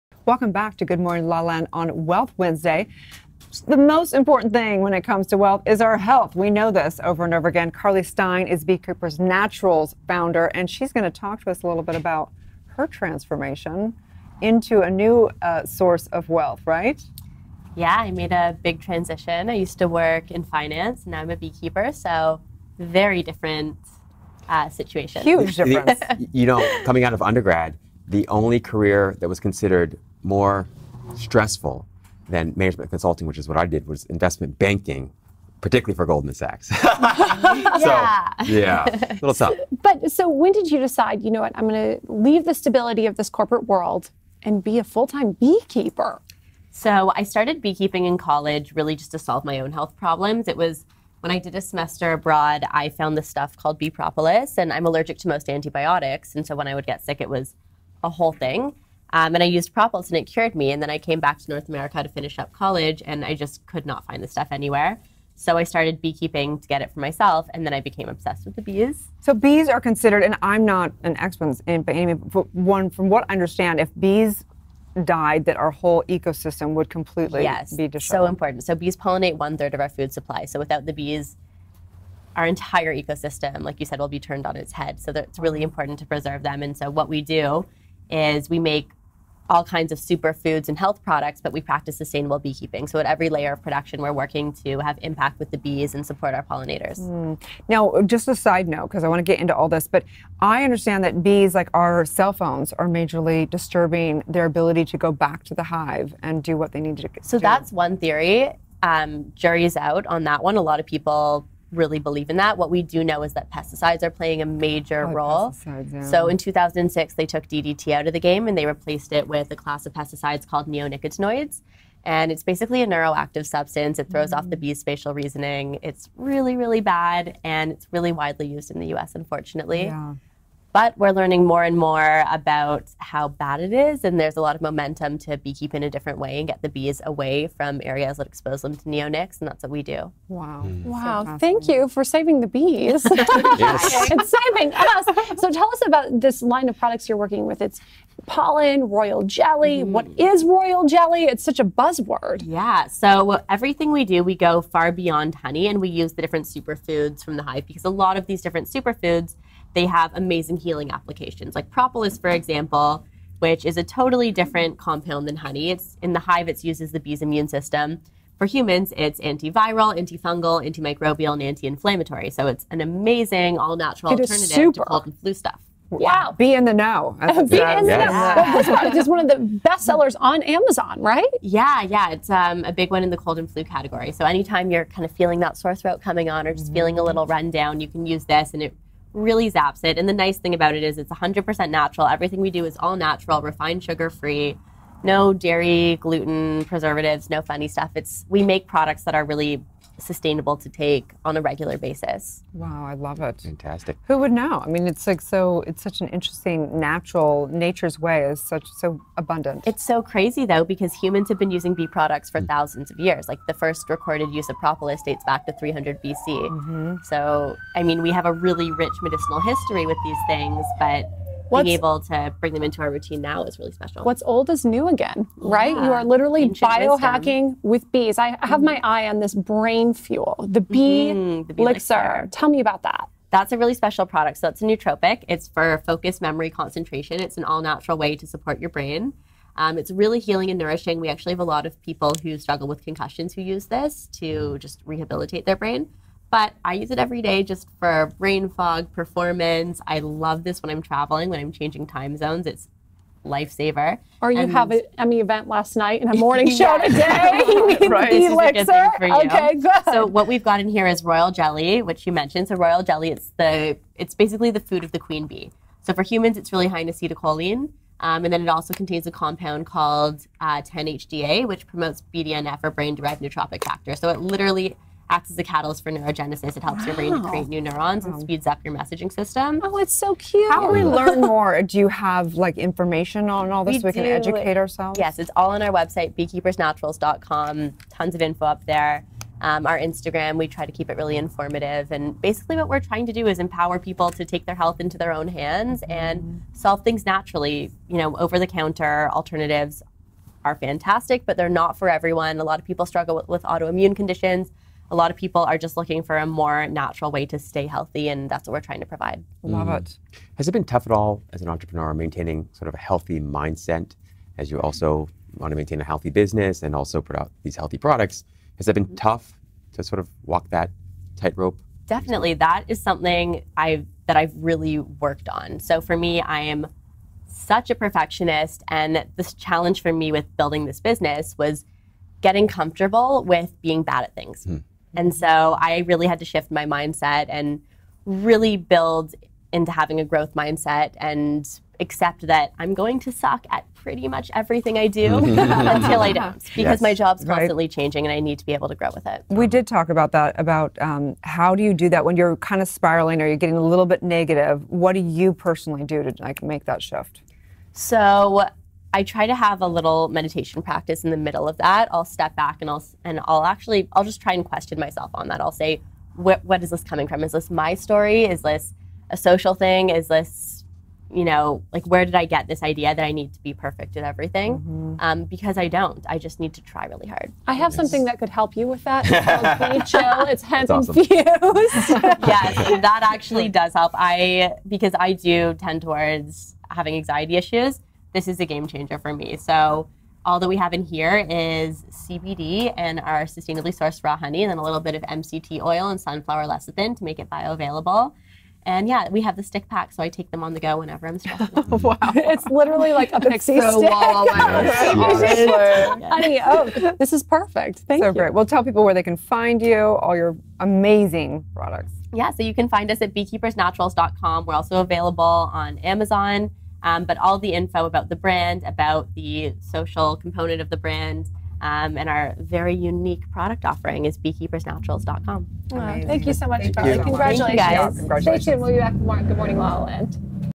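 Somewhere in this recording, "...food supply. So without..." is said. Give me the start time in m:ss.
1:19.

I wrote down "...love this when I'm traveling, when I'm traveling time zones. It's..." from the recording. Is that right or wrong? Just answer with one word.
wrong.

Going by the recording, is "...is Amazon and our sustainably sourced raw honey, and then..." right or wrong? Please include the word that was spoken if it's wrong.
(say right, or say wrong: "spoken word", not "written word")
wrong: "CBD", not "Amazon".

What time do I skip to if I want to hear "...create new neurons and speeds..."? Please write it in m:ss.
4:37.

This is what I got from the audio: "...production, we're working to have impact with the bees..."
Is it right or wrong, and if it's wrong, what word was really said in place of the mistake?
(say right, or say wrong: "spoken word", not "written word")
right.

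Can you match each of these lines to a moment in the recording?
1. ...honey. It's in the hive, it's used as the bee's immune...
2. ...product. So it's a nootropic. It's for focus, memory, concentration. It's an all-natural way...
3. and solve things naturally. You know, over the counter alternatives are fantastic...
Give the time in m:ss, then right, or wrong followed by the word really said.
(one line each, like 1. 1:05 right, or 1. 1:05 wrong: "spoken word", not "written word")
1. 2:45 right
2. 3:54 right
3. 4:56 right.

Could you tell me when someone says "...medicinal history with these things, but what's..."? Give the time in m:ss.
3:39.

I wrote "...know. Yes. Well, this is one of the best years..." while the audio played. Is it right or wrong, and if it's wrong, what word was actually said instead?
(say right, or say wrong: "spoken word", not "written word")
wrong: "sellers", not "years".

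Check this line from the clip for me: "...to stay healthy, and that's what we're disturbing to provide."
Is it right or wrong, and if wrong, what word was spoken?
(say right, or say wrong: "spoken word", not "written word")
wrong: "trying", not "disturbing".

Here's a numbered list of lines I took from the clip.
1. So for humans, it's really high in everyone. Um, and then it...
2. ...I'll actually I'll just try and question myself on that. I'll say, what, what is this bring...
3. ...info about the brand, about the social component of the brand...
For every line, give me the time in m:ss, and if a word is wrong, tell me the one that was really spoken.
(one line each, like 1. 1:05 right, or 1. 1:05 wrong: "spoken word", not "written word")
1. 4:25 wrong: "acetylcholine", not "everyone"
2. 6:03 wrong: "coming", not "bring"
3. 6:57 right.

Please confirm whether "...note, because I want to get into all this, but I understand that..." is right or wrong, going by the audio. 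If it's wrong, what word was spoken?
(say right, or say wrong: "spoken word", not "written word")
right.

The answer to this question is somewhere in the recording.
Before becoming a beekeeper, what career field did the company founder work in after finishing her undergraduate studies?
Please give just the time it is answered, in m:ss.
0:32.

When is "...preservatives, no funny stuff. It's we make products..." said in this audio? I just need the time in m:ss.
3:16.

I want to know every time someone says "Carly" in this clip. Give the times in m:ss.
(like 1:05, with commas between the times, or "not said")
0:07, 7:06.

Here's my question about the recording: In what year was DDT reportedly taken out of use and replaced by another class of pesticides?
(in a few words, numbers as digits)
2006.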